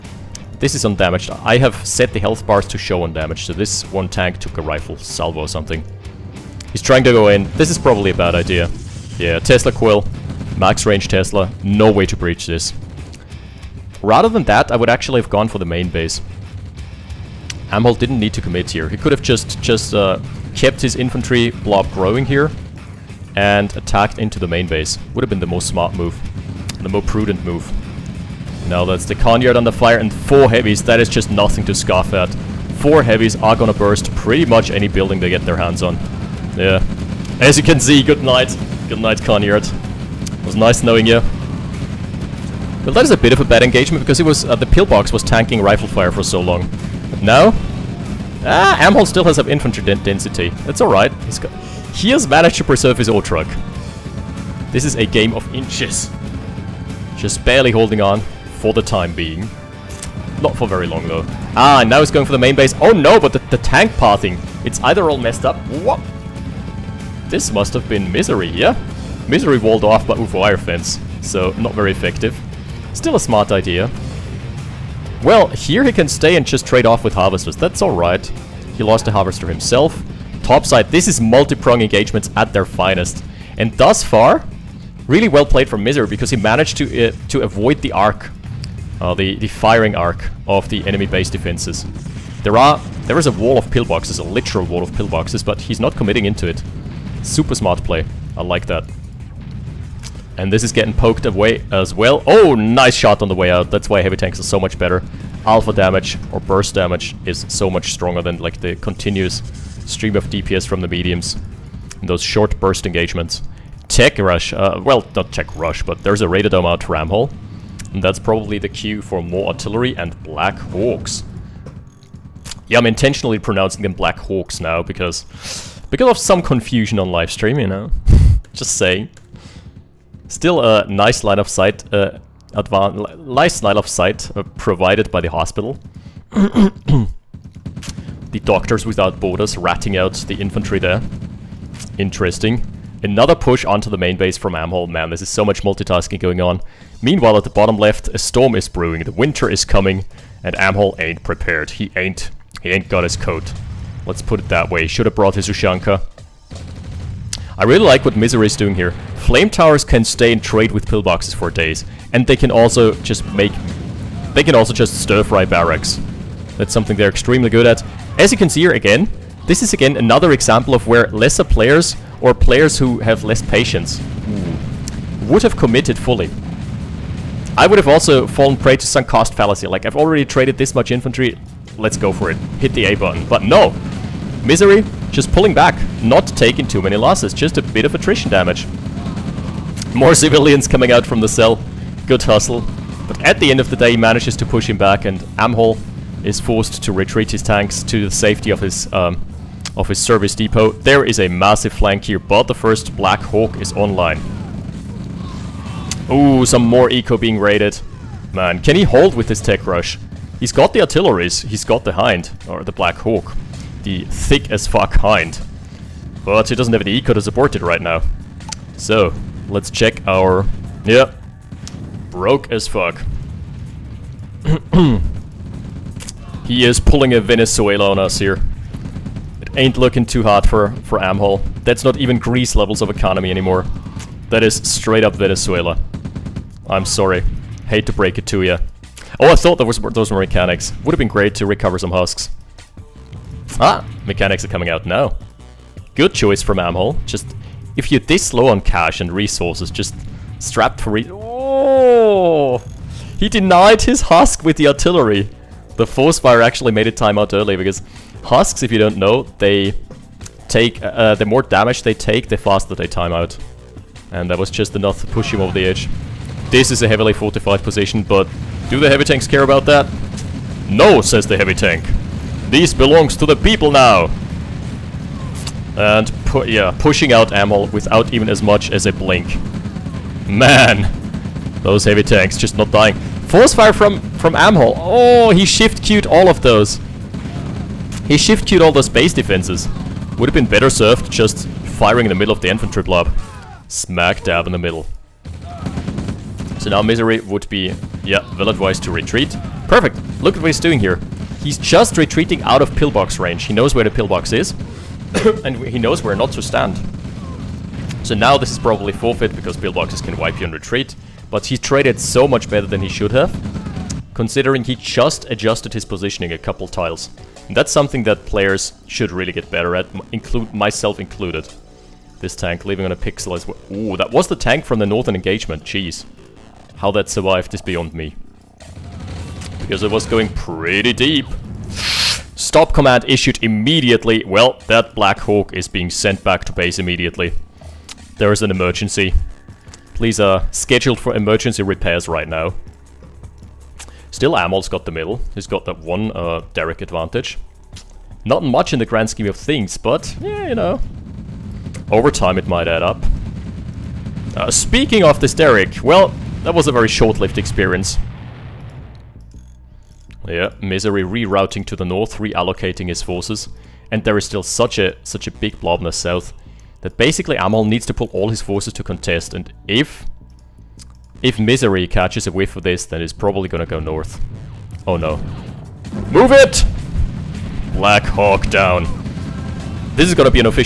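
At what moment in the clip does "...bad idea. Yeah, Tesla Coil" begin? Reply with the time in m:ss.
0:08.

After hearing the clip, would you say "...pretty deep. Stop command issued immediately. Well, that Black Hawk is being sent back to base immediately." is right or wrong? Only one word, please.
right.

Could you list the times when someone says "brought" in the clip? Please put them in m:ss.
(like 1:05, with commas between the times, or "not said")
2:35.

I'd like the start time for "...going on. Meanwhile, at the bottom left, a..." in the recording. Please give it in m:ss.
2:26.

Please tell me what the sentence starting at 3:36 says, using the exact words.
But he doesn't have the eco to support it right now.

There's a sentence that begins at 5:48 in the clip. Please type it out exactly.
Not much in the grand scheme of things, but, yeah, you know.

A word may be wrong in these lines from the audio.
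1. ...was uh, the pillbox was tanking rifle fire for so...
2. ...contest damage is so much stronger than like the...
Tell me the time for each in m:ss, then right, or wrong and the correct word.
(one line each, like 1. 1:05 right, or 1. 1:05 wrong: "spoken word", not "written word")
1. 0:44 right
2. 1:46 wrong: "burst", not "contest".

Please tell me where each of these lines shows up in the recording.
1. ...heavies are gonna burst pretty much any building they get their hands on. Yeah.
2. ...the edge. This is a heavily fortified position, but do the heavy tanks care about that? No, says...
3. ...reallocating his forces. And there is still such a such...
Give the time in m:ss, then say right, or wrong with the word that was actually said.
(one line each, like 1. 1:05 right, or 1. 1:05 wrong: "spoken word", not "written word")
1. 0:33 right
2. 4:25 right
3. 6:02 right.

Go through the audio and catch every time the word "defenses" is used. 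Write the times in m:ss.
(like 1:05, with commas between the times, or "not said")
1:31, 4:49.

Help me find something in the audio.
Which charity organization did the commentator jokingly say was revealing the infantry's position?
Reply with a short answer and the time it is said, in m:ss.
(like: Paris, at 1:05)
Doctors Without Borders, at 2:18.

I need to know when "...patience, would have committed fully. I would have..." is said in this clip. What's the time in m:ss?
2:53.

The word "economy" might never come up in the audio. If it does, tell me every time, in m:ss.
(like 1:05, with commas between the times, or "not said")
3:52.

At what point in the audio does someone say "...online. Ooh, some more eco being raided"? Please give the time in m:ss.
3:23.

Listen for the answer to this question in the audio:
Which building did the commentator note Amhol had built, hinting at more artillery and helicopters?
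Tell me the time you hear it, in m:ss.
1:56.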